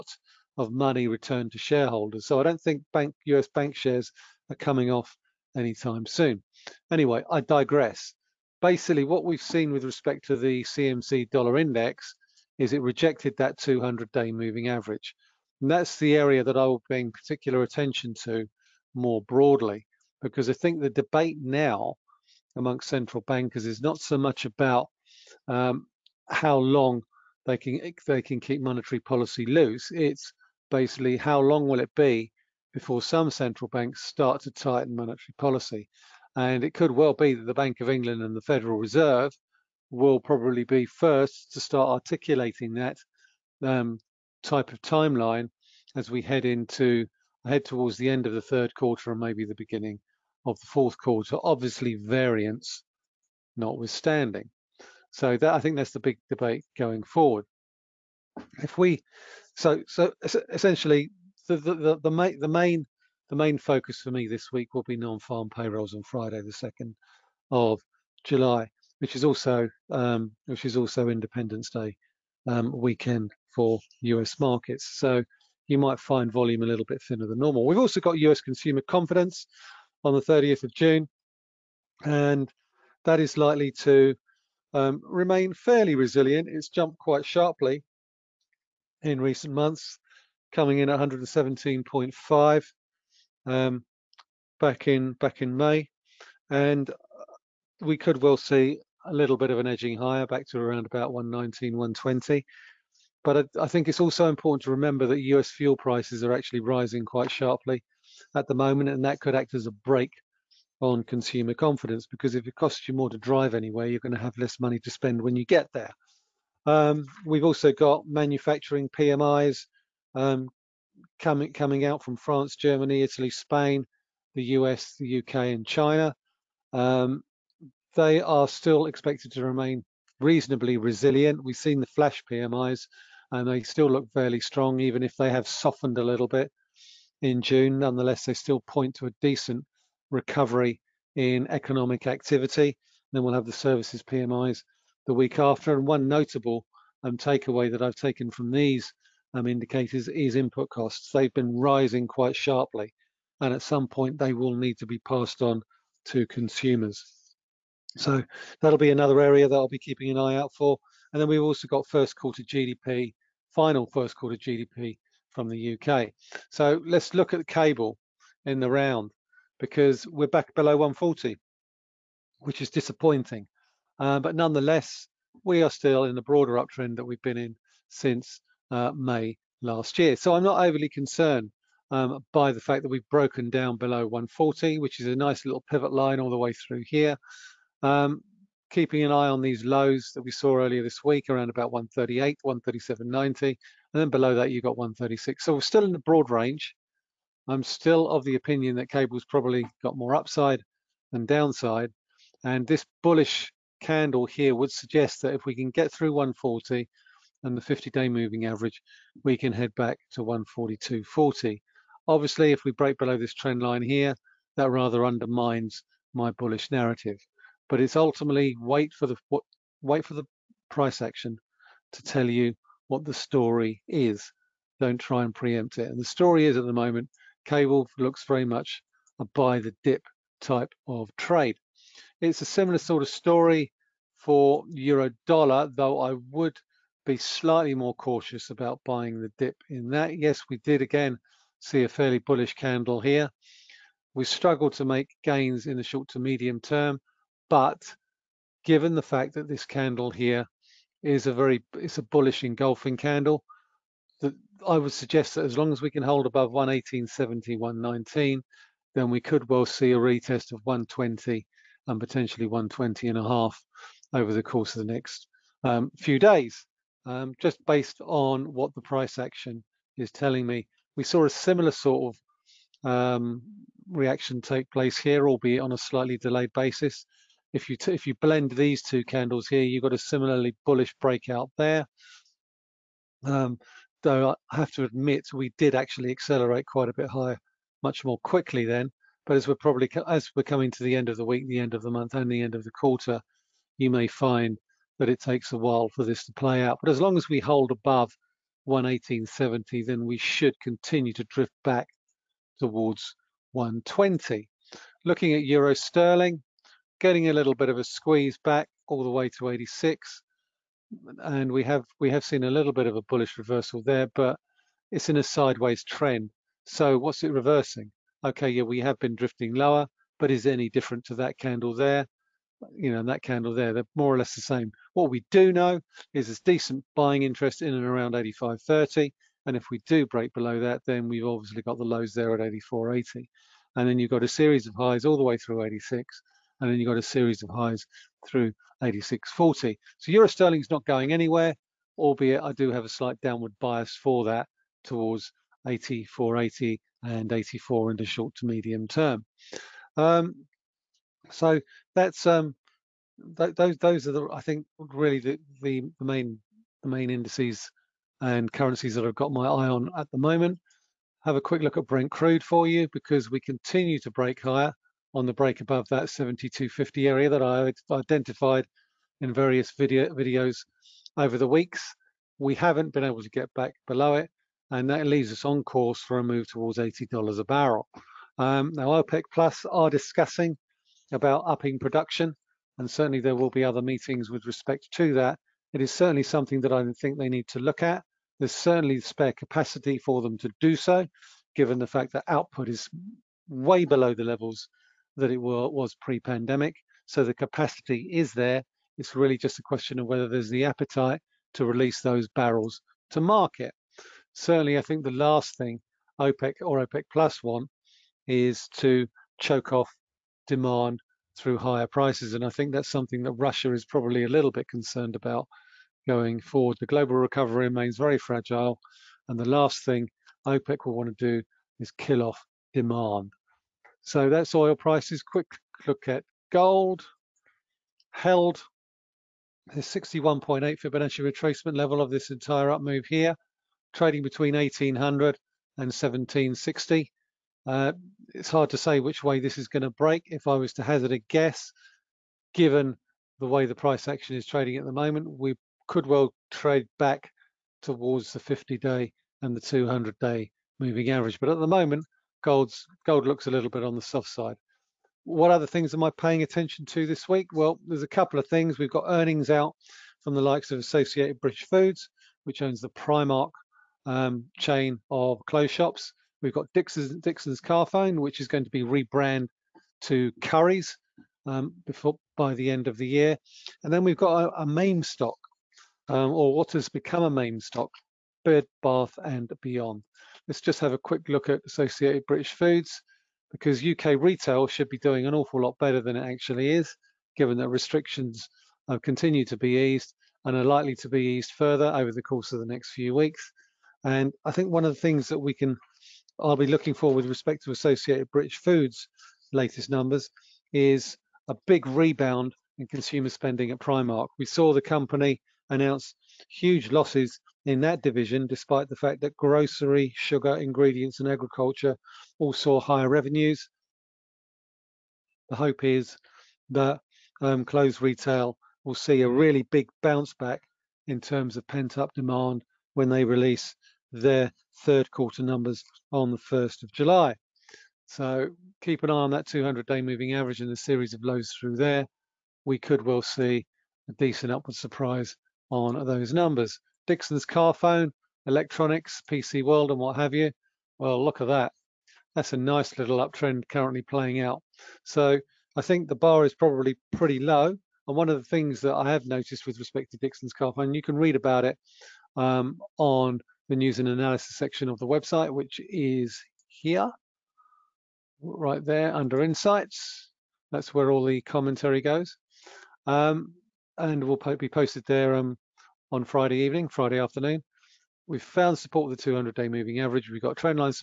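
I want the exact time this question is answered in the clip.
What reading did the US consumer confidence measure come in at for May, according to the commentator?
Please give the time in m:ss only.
1:30.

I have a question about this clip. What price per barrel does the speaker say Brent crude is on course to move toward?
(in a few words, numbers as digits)
$80.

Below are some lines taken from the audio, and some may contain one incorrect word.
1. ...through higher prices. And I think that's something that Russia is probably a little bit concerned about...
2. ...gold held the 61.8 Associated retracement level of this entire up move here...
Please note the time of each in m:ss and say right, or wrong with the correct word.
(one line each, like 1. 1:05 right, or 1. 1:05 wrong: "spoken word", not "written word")
1. 6:51 right
2. 7:06 wrong: "Fibonacci", not "Associated".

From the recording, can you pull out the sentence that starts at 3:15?
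So we're still in the broad range.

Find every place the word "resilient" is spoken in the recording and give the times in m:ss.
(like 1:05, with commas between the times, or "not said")
1:25, 2:10.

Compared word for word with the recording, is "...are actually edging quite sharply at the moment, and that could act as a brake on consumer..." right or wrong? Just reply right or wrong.
wrong.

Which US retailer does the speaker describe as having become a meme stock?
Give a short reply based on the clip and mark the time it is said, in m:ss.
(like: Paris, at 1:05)
Bed, Bath and Beyond, at 7:58.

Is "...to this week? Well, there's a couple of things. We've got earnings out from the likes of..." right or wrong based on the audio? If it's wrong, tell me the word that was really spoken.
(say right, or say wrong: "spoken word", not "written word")
right.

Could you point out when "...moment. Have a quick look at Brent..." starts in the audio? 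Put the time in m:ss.
6:00.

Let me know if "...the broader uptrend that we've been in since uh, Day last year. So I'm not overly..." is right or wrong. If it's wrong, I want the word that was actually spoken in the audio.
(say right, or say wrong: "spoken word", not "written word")
wrong: "May", not "Day".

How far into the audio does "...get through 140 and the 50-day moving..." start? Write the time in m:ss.
3:25.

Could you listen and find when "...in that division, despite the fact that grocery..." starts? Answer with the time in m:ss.
8:27.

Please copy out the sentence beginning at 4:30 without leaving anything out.
We saw a similar sort of um, reaction take place here, albeit on a slightly delayed basis.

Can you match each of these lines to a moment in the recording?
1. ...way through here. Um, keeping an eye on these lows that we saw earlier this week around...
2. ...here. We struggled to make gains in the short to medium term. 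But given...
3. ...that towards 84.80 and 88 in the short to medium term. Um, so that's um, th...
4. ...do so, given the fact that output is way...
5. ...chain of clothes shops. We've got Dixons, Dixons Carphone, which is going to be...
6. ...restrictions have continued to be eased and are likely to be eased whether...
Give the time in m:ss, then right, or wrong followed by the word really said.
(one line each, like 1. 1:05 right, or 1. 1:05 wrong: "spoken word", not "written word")
1. 3:06 right
2. 4:03 right
3. 5:44 wrong: "84", not "88"
4. 6:30 right
5. 7:44 right
6. 8:07 wrong: "further", not "whether".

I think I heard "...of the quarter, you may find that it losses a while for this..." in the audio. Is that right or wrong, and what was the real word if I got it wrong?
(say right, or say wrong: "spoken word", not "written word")
wrong: "takes", not "losses".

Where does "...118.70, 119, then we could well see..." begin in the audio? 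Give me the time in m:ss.
4:16.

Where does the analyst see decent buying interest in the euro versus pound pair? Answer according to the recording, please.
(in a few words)
85.30.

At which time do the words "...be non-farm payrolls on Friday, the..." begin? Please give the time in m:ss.
1:04.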